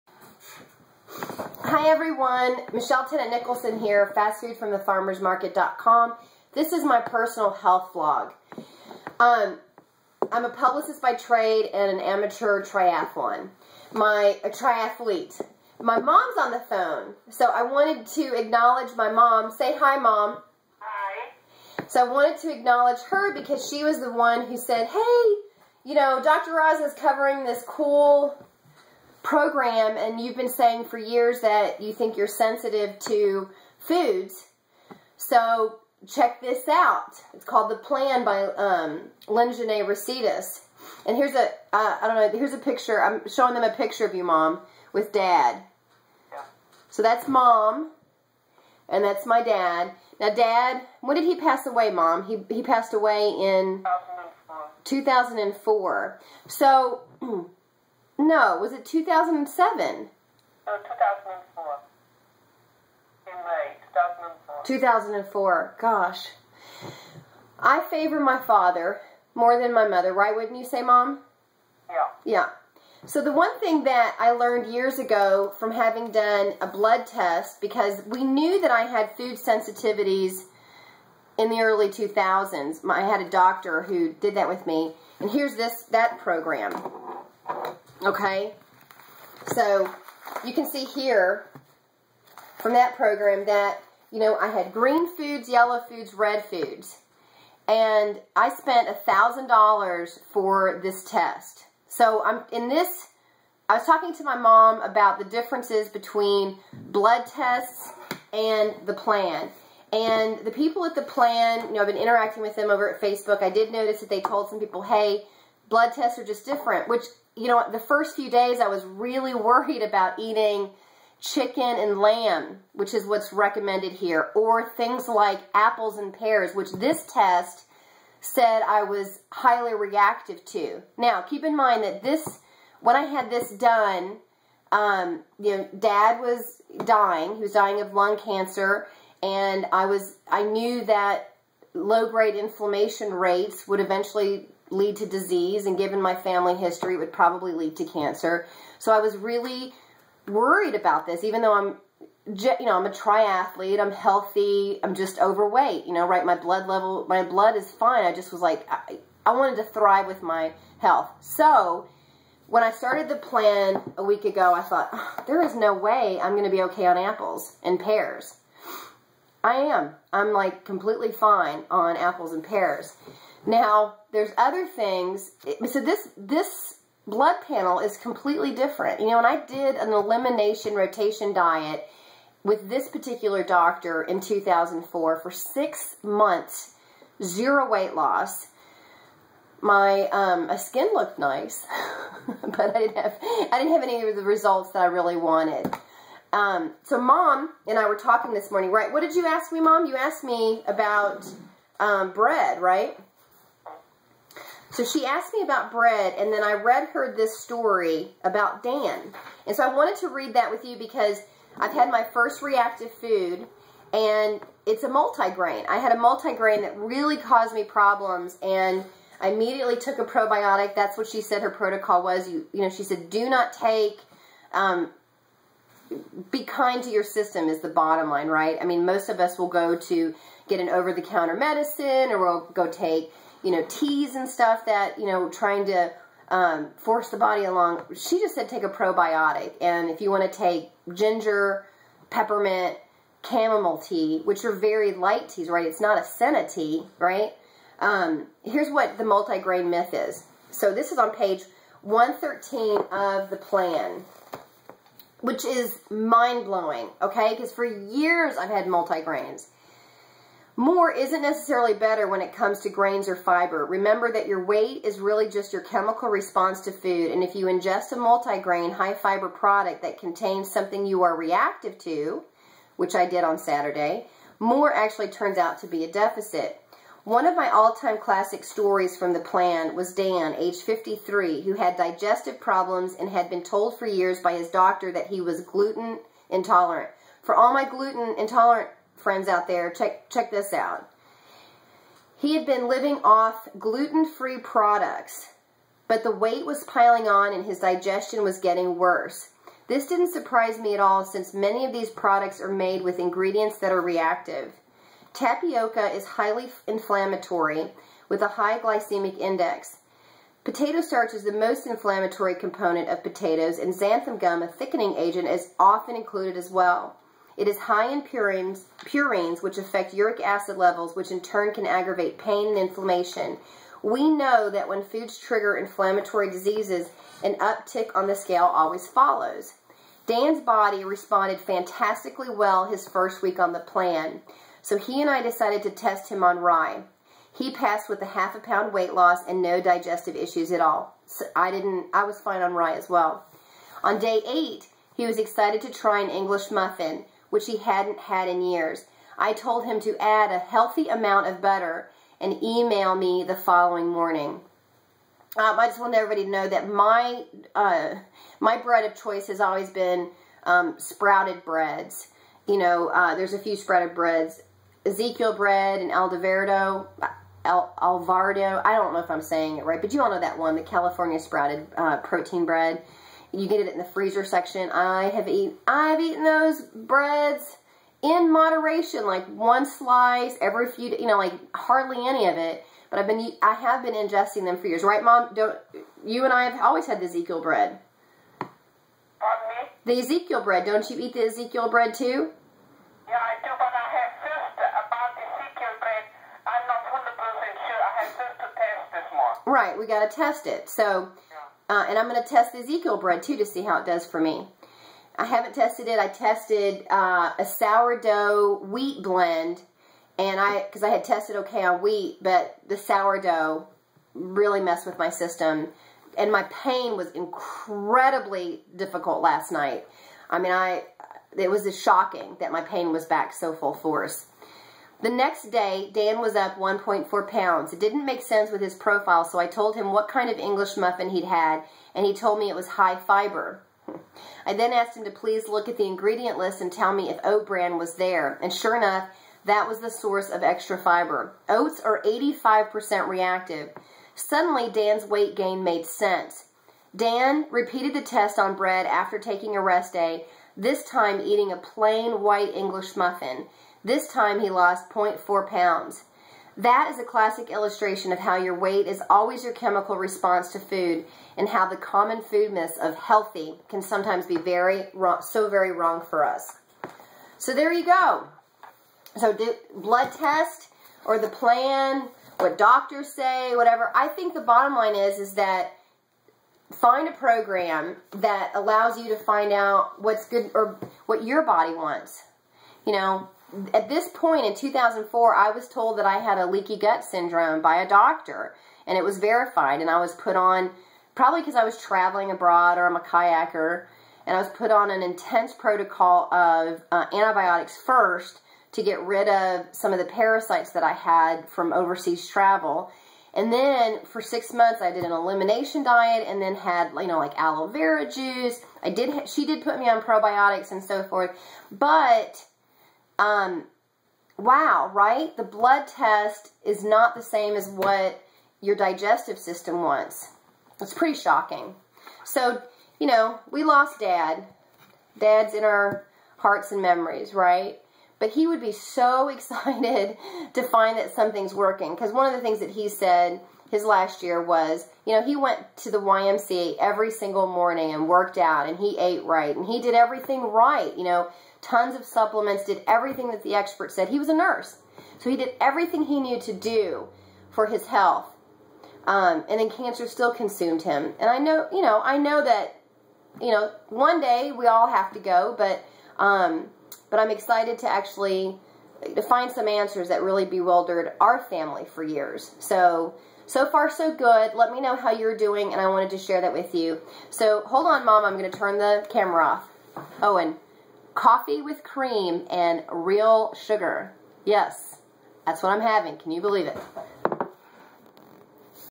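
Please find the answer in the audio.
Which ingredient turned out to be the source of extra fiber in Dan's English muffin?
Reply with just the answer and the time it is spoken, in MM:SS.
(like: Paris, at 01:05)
oat bran, at 07:17.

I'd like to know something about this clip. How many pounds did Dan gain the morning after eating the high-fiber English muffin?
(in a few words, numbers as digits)
1.4.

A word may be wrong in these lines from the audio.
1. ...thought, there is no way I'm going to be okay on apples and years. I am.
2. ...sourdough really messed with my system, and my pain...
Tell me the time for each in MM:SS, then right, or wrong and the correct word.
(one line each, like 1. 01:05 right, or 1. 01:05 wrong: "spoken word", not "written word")
1. 02:44 wrong: "pears", not "years"
2. 06:52 right.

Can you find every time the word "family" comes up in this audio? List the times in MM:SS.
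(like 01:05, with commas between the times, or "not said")
02:26, 09:21.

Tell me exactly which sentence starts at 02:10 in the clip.
Now, keep in mind that this, when I had this done, um, you know, dad was dying.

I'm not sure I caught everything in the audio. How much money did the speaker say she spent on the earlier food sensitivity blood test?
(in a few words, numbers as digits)
$1,000.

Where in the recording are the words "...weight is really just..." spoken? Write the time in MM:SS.
04:24.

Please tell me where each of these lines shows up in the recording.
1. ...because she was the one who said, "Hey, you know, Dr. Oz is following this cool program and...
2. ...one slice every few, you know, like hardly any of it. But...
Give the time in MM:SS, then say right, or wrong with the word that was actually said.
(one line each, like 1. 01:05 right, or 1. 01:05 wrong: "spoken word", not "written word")
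1. 00:23 wrong: "covering", not "following"
2. 06:19 right.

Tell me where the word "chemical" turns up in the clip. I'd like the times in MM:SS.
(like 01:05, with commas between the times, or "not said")
04:25, 07:39.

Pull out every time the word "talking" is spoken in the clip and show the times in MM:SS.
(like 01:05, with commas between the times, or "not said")
01:43, 03:17.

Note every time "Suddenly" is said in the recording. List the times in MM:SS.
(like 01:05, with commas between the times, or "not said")
07:24.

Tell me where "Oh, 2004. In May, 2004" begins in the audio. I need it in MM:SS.
01:00.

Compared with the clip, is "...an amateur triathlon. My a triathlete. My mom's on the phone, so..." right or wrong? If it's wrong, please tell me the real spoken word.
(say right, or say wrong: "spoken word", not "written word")
right.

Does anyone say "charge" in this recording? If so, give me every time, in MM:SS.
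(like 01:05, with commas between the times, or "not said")
not said.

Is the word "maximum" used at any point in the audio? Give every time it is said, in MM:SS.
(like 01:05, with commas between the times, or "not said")
not said.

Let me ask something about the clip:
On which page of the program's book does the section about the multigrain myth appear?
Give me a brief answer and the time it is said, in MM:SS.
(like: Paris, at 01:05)
113, at 04:11.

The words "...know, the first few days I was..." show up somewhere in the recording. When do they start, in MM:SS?
01:57.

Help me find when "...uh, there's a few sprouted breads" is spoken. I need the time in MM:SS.
06:02.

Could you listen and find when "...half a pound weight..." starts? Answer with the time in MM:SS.
05:38.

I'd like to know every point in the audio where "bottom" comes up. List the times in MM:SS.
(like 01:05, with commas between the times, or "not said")
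03:47, 07:54.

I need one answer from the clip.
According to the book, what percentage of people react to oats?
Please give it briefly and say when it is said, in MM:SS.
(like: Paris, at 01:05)
85%, at 07:22.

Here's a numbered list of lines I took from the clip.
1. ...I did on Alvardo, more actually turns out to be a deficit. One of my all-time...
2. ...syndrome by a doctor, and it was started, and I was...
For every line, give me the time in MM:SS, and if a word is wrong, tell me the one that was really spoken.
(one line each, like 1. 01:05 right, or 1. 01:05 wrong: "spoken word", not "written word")
1. 04:32 wrong: "Saturday", not "Alvardo"
2. 08:07 wrong: "verified", not "started".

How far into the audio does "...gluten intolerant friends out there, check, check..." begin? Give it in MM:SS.
04:47.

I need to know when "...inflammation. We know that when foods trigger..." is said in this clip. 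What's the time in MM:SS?
05:22.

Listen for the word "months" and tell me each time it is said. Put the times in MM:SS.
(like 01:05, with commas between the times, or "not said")
03:06, 08:24.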